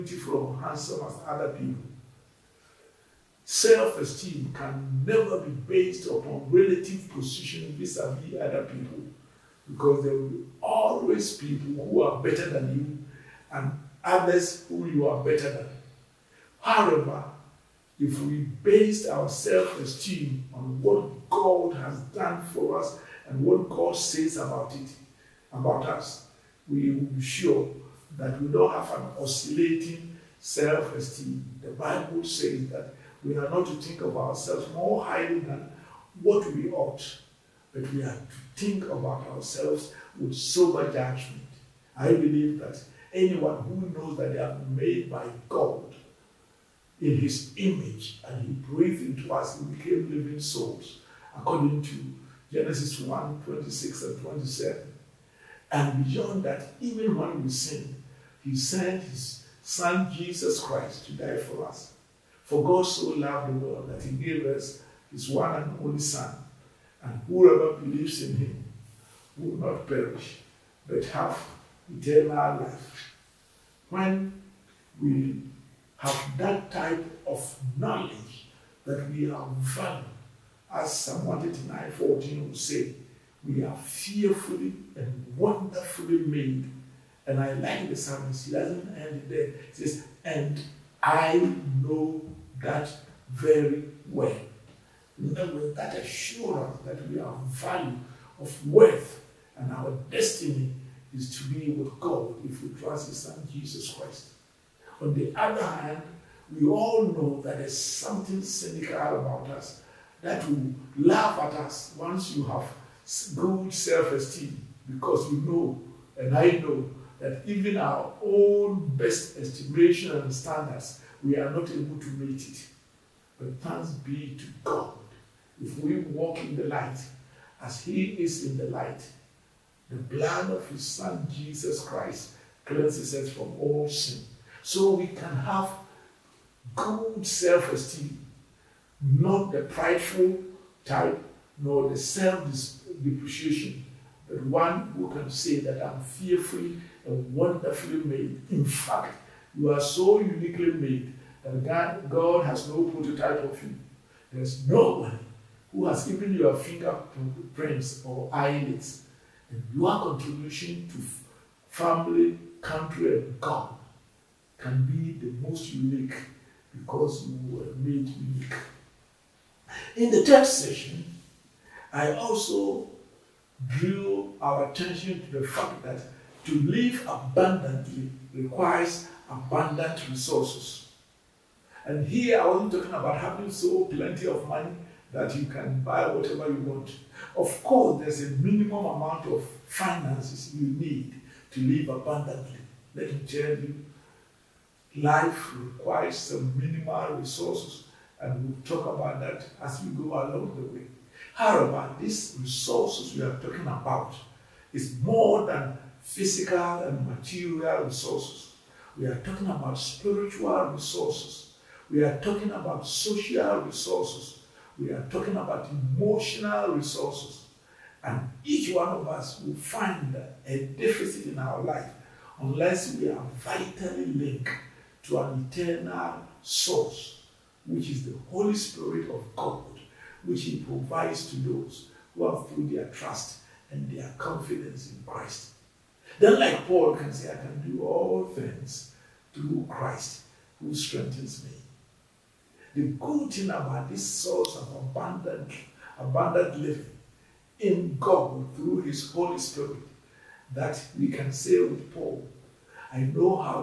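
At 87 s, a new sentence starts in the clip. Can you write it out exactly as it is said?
And I like the psalmist, he doesn't end there.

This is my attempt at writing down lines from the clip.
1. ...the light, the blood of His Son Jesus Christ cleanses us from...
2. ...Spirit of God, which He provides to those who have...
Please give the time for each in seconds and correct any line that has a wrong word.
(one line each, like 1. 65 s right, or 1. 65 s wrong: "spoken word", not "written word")
1. 128 s right
2. 228 s right.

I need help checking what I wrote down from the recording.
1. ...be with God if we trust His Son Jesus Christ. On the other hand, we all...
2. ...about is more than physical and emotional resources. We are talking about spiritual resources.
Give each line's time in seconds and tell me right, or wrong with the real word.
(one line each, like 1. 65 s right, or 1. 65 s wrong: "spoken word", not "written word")
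1. 101 s right
2. 203 s wrong: "material", not "emotional".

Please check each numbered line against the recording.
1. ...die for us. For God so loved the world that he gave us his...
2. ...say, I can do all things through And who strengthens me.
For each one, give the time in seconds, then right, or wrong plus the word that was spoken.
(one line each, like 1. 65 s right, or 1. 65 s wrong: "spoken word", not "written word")
1. 61 s right
2. 237 s wrong: "Christ", not "And".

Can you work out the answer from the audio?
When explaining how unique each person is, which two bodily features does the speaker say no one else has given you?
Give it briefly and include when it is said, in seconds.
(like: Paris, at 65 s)
fingerprints or eyelids, at 156 s.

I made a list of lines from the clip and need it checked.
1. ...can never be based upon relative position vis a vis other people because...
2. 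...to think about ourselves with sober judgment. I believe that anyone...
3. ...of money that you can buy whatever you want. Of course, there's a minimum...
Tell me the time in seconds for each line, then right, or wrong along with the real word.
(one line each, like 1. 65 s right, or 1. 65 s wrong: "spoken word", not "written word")
1. 4 s right
2. 38 s right
3. 184 s right.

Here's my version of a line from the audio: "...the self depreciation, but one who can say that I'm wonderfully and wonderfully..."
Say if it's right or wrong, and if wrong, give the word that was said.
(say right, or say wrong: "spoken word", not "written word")
wrong: "fearfully", not "wonderfully".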